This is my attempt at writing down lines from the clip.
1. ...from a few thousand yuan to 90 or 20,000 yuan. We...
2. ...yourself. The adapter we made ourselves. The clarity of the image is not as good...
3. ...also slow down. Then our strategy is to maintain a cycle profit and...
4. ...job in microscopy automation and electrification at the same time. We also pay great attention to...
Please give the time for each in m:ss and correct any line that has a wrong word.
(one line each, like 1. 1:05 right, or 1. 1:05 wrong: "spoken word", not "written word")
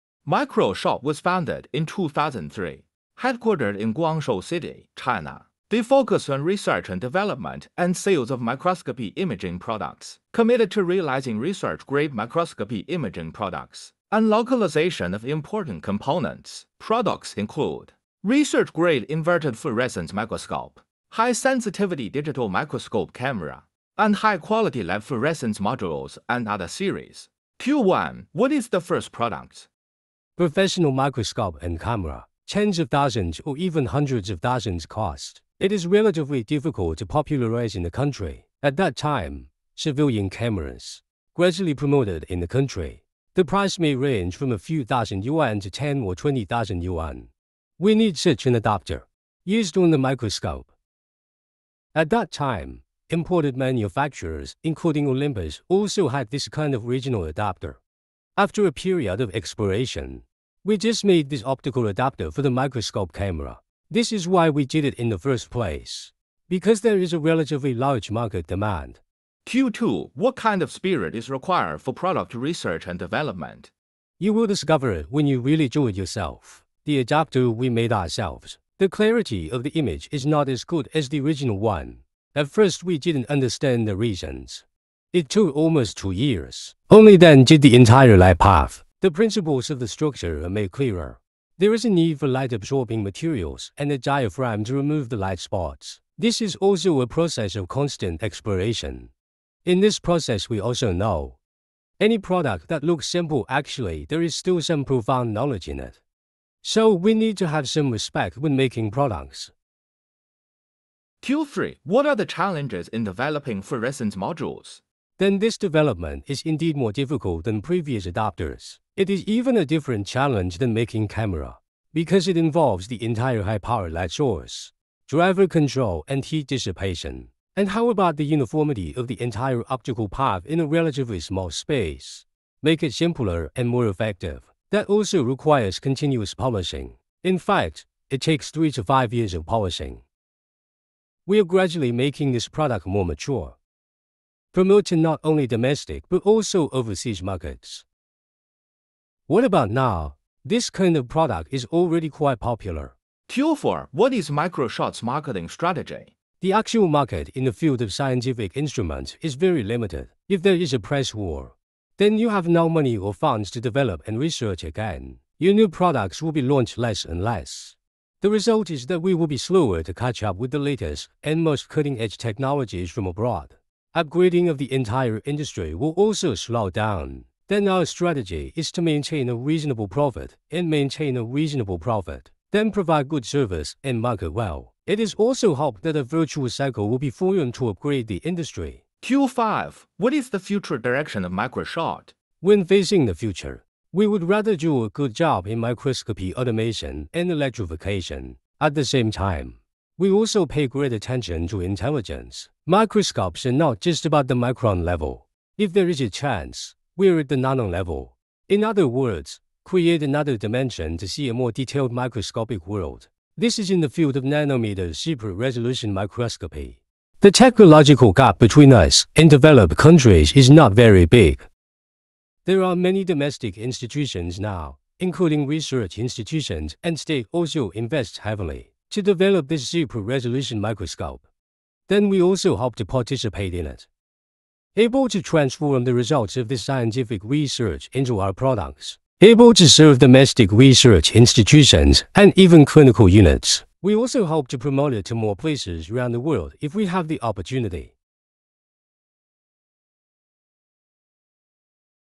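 1. 0:44 wrong: "10", not "90"
2. 1:15 right
3. 2:55 wrong: "reasonable", not "cycle"
4. 3:15 right.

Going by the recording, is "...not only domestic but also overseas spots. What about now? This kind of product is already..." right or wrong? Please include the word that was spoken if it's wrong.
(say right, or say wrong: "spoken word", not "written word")
wrong: "markets", not "spots".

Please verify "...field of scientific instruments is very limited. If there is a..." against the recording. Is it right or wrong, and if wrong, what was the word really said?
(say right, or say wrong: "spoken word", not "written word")
right.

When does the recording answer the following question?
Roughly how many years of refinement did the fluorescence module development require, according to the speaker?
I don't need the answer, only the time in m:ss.
2:18.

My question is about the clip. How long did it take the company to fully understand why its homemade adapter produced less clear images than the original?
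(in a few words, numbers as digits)
Almost 2 years.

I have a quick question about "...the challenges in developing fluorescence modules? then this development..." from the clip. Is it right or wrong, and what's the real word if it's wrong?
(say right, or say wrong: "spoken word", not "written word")
right.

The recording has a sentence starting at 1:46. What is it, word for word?
So we need to have some respect when making products.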